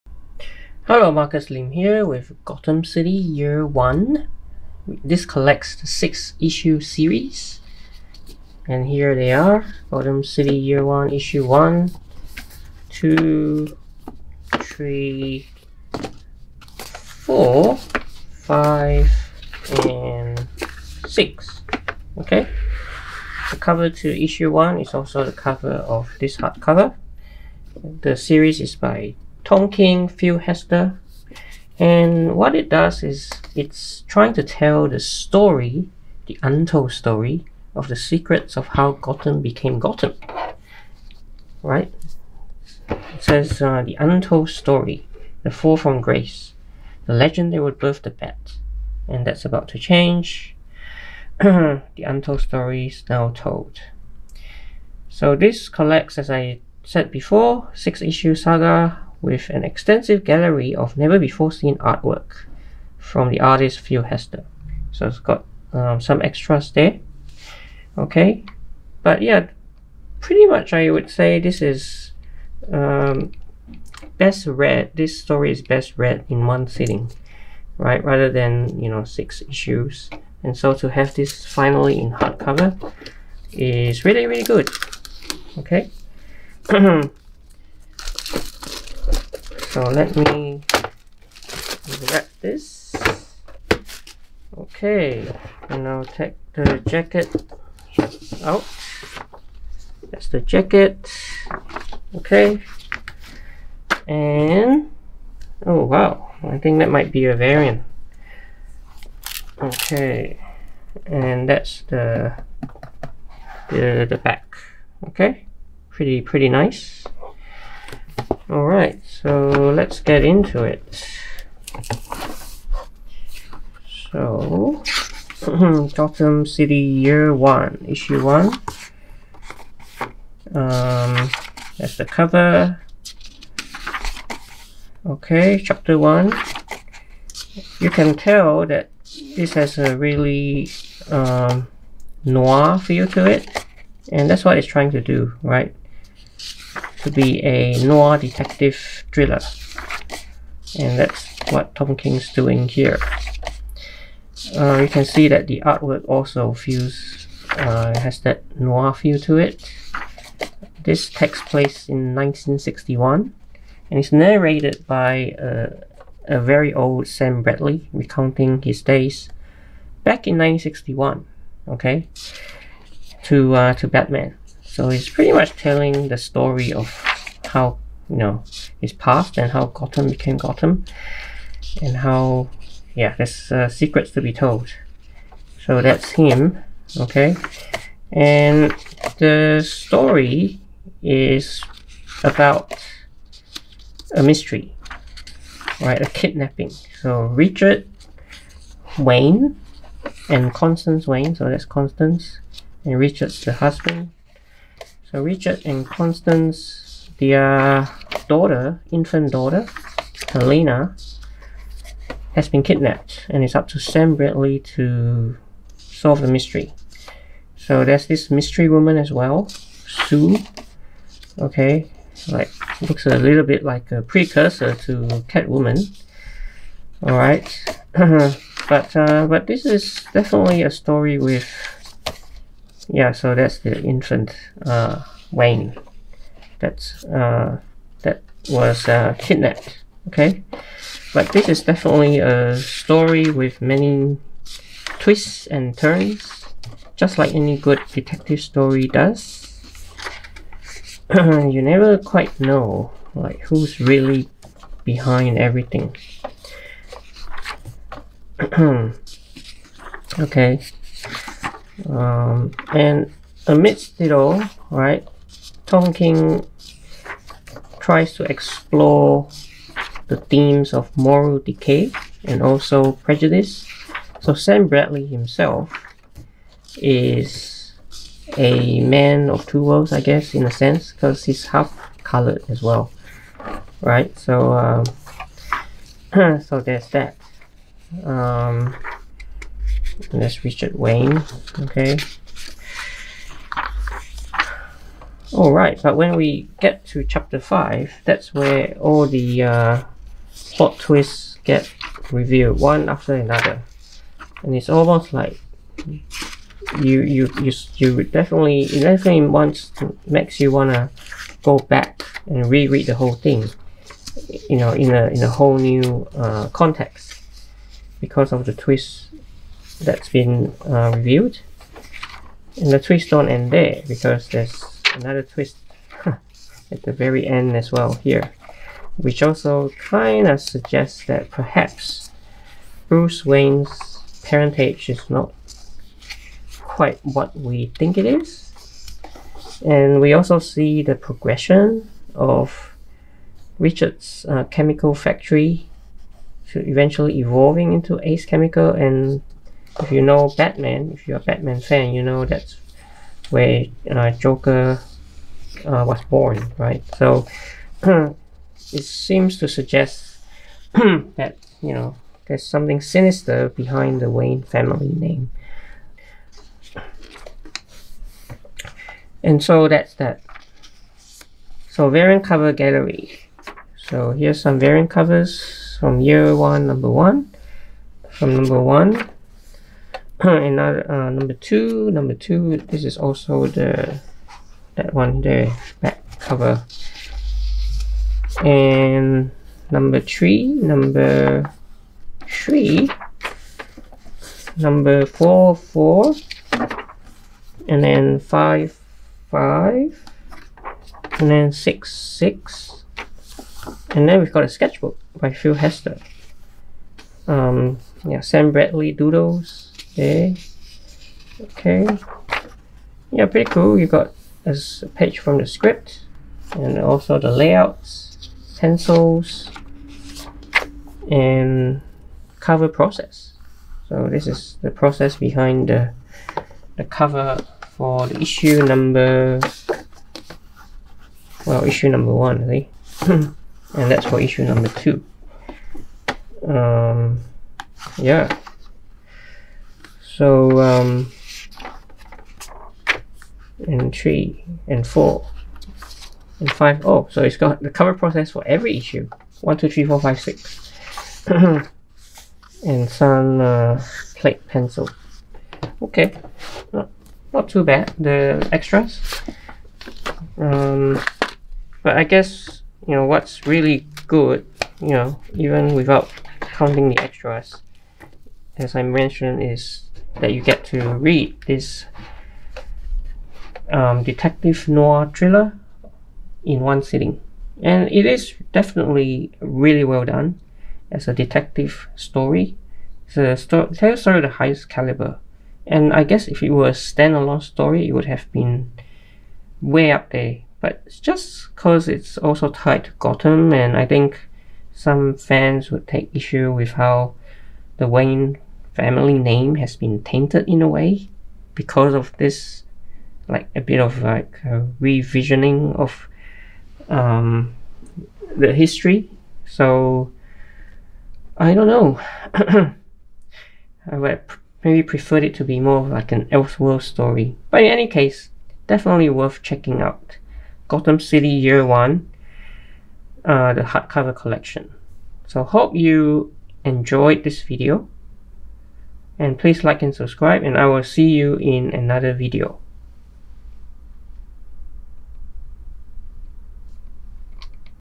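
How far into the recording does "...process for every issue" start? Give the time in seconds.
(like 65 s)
447 s.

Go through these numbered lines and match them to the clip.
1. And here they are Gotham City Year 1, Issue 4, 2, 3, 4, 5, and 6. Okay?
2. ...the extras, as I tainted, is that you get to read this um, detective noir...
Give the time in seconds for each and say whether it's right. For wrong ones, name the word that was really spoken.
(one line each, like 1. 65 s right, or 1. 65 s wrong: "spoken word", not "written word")
1. 8 s wrong: "1", not "4"
2. 466 s wrong: "mentioned", not "tainted".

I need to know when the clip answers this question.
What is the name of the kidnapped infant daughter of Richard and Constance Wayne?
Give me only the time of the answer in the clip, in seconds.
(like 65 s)
210 s.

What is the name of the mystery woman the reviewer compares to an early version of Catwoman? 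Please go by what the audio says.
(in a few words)
Sue.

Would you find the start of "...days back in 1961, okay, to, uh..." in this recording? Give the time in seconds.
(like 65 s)
168 s.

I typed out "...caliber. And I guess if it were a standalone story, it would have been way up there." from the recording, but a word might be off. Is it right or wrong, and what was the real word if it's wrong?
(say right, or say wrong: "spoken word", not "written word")
right.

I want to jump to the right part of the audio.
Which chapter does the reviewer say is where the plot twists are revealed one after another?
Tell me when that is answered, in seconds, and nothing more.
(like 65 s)
297 s.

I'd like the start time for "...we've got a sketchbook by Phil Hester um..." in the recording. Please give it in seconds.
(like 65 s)
404 s.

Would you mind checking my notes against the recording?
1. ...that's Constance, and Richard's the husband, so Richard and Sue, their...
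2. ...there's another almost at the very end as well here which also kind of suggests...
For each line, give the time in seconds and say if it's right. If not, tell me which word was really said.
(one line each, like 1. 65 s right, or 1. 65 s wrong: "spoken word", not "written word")
1. 201 s wrong: "Constance", not "Sue"
2. 324 s wrong: "twist", not "almost".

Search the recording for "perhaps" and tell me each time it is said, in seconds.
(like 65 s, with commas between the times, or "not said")
331 s.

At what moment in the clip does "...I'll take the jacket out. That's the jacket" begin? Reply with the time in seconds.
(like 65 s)
95 s.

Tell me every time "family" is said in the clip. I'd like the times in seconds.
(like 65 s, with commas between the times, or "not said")
364 s, 498 s.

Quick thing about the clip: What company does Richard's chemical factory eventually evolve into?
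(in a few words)
Ace Chemical.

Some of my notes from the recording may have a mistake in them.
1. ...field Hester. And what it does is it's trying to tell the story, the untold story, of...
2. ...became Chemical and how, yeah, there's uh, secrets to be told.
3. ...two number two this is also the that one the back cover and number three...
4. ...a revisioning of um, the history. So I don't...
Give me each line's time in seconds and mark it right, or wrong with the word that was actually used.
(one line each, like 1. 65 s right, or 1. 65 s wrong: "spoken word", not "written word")
1. 30 s right
2. 180 s wrong: "Gotham", not "Chemical"
3. 381 s right
4. 504 s right.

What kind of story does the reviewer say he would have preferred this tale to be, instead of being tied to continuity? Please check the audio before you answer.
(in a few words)
Elseworld story.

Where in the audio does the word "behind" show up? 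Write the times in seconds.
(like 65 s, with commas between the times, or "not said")
254 s, 363 s, 425 s.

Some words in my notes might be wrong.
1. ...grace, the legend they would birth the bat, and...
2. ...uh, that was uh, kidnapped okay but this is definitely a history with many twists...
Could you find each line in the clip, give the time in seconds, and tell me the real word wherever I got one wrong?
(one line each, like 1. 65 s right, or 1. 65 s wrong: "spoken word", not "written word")
1. 45 s right
2. 237 s wrong: "story", not "history".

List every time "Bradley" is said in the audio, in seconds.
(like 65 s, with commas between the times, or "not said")
167 s, 214 s, 274 s, 408 s.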